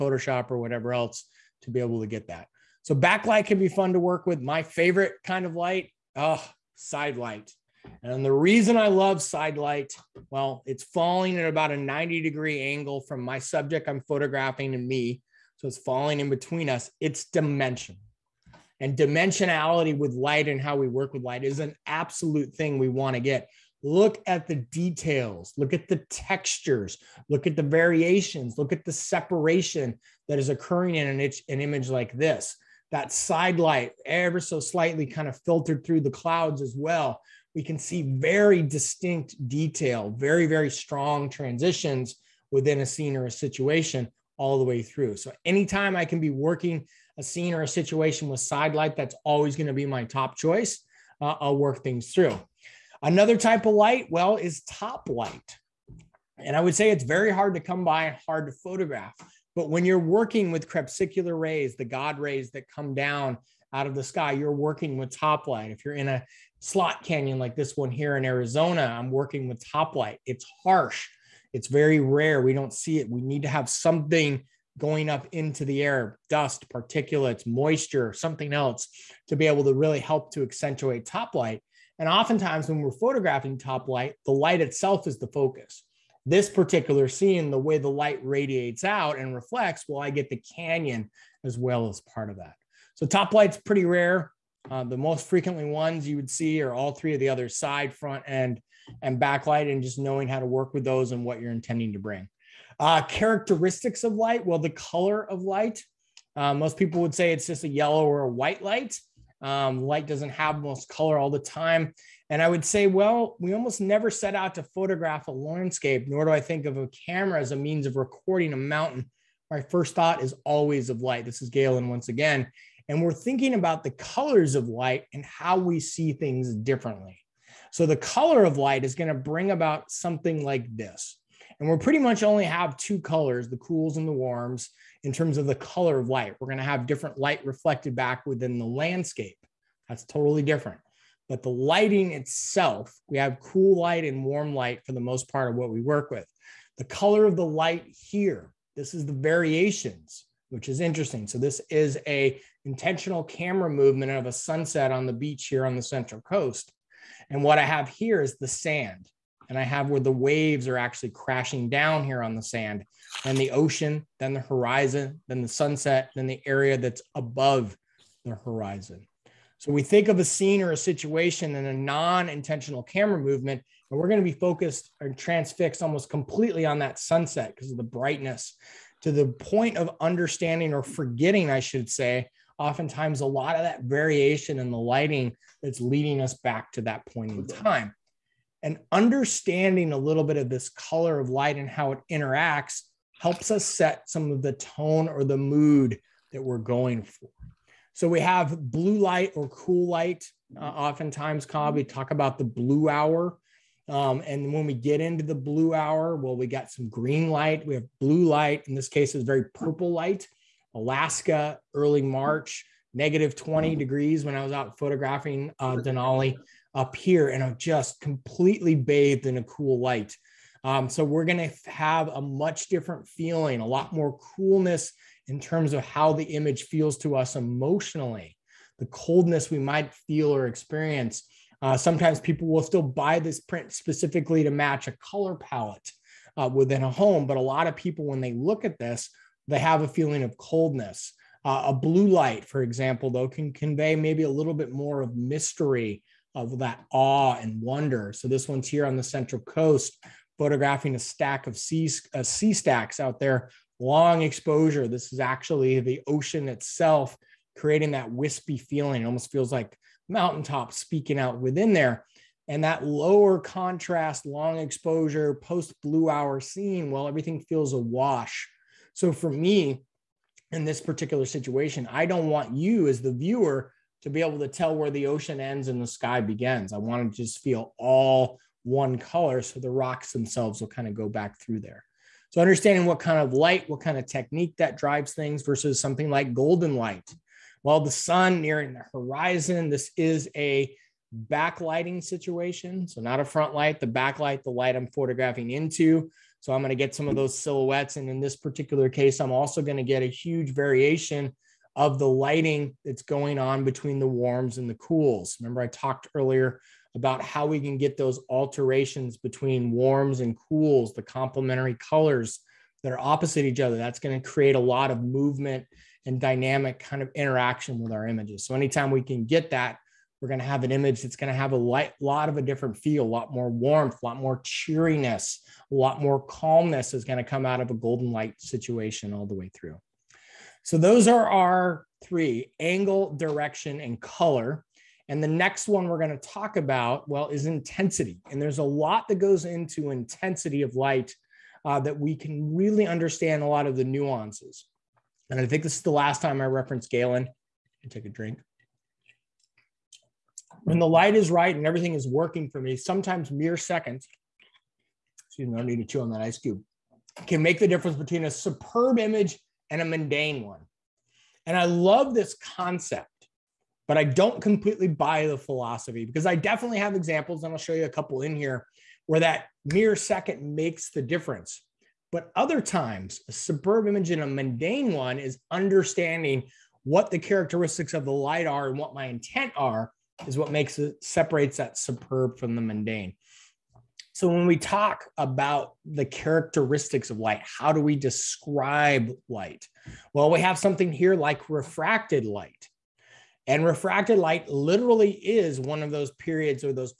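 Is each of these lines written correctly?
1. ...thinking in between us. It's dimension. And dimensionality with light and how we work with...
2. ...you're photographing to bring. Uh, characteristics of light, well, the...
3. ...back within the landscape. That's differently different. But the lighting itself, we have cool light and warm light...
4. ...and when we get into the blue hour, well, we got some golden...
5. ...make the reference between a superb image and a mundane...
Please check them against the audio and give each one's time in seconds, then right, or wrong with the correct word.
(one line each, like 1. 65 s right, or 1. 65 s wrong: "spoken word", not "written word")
1. 15 s wrong: "falling", not "thinking"
2. 101 s wrong: "intending", not "photographing"
3. 137 s wrong: "totally", not "differently"
4. 204 s wrong: "green", not "golden"
5. 357 s wrong: "difference", not "reference".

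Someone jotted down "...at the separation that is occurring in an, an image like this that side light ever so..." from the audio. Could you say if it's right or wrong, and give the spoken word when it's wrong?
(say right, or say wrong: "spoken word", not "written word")
right.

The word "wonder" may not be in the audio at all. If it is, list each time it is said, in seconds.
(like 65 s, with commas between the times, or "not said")
247 s.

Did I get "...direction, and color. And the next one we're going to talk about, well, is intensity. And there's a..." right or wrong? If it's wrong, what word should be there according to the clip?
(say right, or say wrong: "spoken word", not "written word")
right.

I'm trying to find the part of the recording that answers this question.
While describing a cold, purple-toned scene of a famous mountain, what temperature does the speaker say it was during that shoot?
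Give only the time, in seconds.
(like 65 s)
212 s.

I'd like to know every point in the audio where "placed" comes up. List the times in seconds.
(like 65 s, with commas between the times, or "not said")
not said.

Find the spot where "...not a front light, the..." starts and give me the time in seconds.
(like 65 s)
293 s.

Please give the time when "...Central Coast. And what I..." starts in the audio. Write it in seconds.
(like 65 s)
155 s.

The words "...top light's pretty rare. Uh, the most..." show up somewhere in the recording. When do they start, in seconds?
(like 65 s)
93 s.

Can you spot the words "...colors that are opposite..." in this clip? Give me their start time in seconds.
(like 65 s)
311 s.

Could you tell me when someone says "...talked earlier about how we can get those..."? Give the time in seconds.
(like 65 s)
305 s.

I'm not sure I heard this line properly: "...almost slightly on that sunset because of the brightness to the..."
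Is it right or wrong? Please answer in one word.
wrong.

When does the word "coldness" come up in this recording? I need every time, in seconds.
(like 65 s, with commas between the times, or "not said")
228 s, 240 s.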